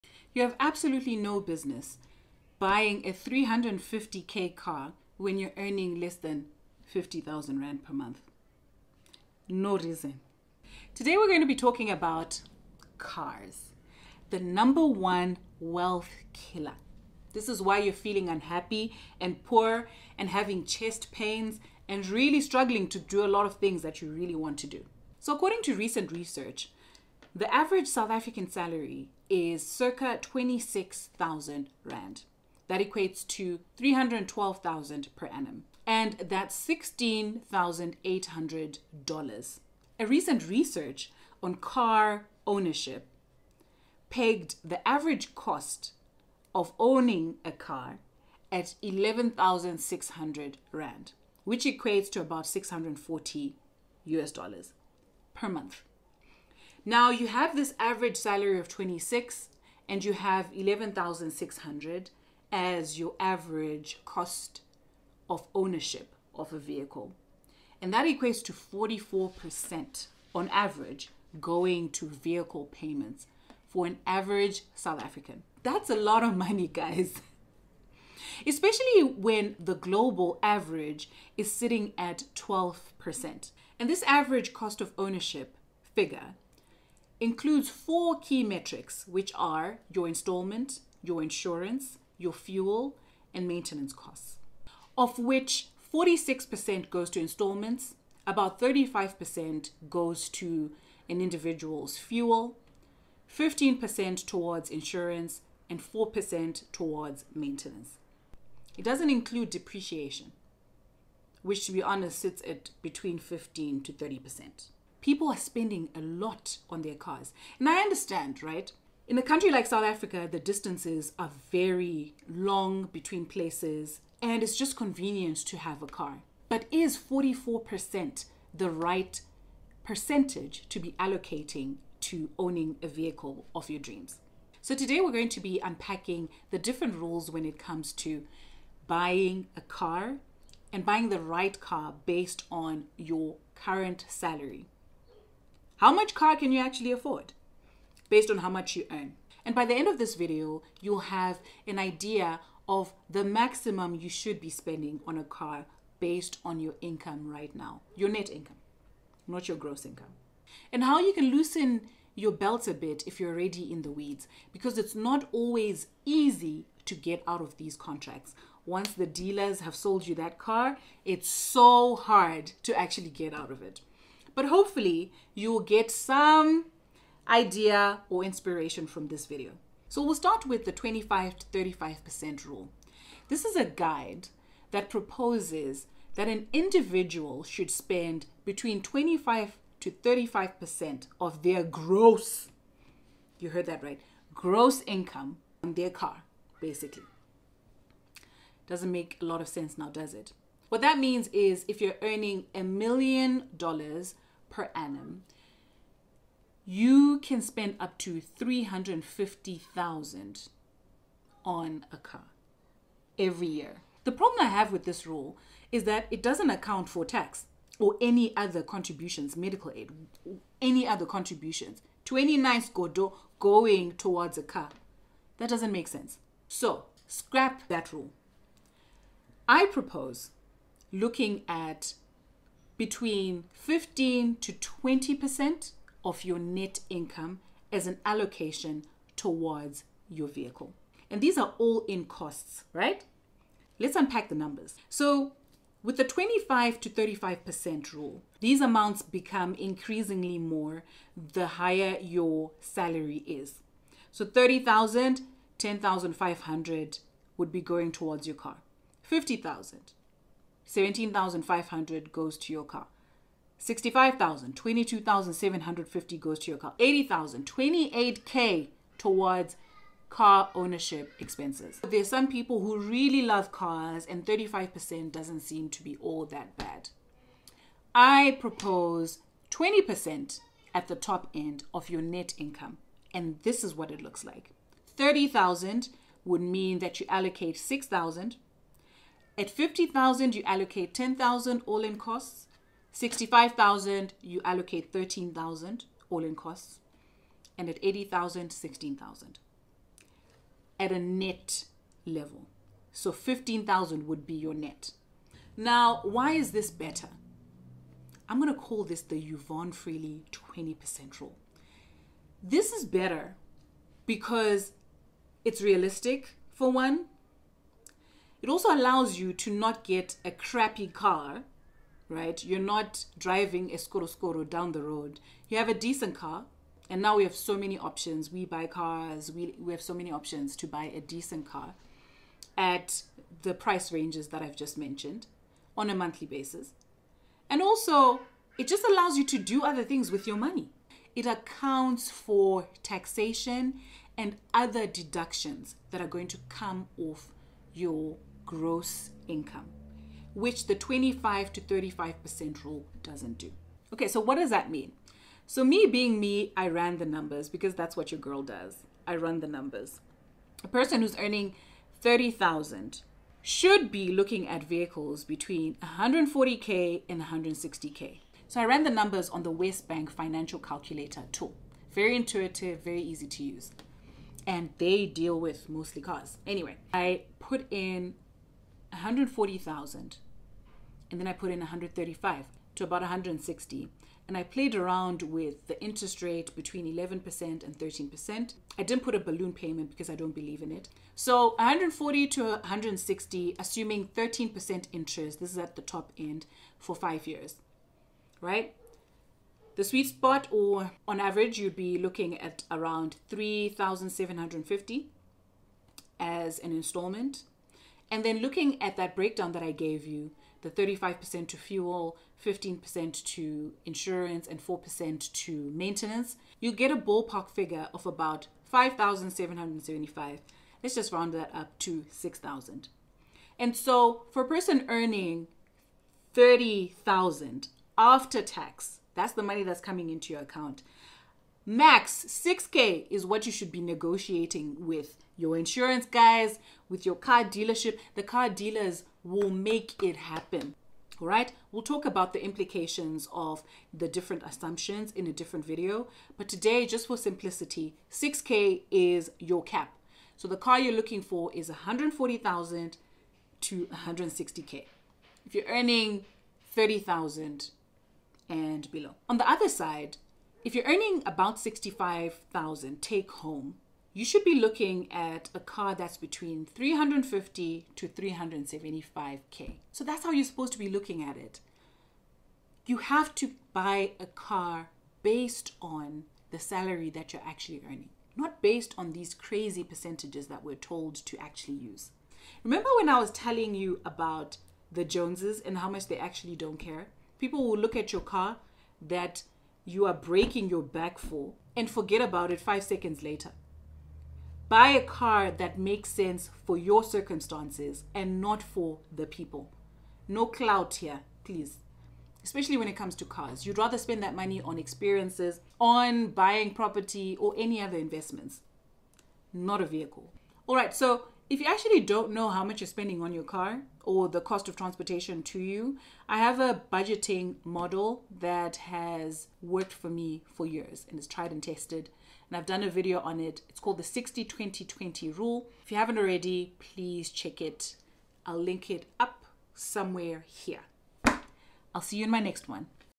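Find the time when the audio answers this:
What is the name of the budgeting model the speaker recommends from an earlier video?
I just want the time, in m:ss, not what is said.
8:44.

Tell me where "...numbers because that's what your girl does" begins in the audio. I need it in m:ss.
5:57.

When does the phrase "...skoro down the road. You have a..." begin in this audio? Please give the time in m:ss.
5:24.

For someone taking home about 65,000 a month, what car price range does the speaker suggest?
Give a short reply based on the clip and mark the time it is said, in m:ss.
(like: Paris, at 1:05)
350k to 375k, at 7:46.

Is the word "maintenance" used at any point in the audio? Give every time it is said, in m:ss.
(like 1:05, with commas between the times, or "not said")
1:33, 1:47, 6:55.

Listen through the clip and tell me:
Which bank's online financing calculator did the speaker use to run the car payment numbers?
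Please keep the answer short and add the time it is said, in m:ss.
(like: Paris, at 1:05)
WesBank, at 6:09.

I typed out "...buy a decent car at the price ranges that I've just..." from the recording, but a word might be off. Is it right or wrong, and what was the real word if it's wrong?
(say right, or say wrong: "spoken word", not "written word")
right.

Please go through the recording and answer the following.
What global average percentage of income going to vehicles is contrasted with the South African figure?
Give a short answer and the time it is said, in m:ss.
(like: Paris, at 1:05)
12%, at 1:22.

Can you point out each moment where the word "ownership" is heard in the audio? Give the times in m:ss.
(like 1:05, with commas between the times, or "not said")
0:42, 1:05, 1:24, 4:30.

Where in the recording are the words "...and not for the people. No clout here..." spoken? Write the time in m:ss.
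8:18.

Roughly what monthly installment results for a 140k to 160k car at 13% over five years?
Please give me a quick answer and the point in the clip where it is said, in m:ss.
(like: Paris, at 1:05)
3,750, at 6:43.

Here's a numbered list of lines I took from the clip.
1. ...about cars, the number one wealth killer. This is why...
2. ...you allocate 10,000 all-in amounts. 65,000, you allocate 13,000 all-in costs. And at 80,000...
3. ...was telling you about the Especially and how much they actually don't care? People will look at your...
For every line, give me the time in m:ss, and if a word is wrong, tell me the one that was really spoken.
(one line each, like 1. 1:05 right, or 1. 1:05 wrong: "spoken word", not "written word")
1. 0:11 right
2. 4:50 wrong: "costs", not "amounts"
3. 8:03 wrong: "Joneses", not "Especially".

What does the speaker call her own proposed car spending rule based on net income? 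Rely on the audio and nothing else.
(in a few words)
Yvonne Freely 20% rule.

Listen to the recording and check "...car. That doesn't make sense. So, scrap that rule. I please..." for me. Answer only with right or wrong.
wrong.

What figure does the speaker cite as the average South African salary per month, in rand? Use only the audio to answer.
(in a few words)
26,000.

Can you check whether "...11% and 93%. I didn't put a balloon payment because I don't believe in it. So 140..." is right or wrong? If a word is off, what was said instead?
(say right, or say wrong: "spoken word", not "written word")
wrong: "13", not "93".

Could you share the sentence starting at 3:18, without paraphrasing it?
Doesn't make a lot of sense now, does it?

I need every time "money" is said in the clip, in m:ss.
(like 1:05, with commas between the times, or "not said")
1:16, 5:40, 7:09, 8:24.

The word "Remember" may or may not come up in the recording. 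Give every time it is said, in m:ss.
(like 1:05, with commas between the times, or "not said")
8:02.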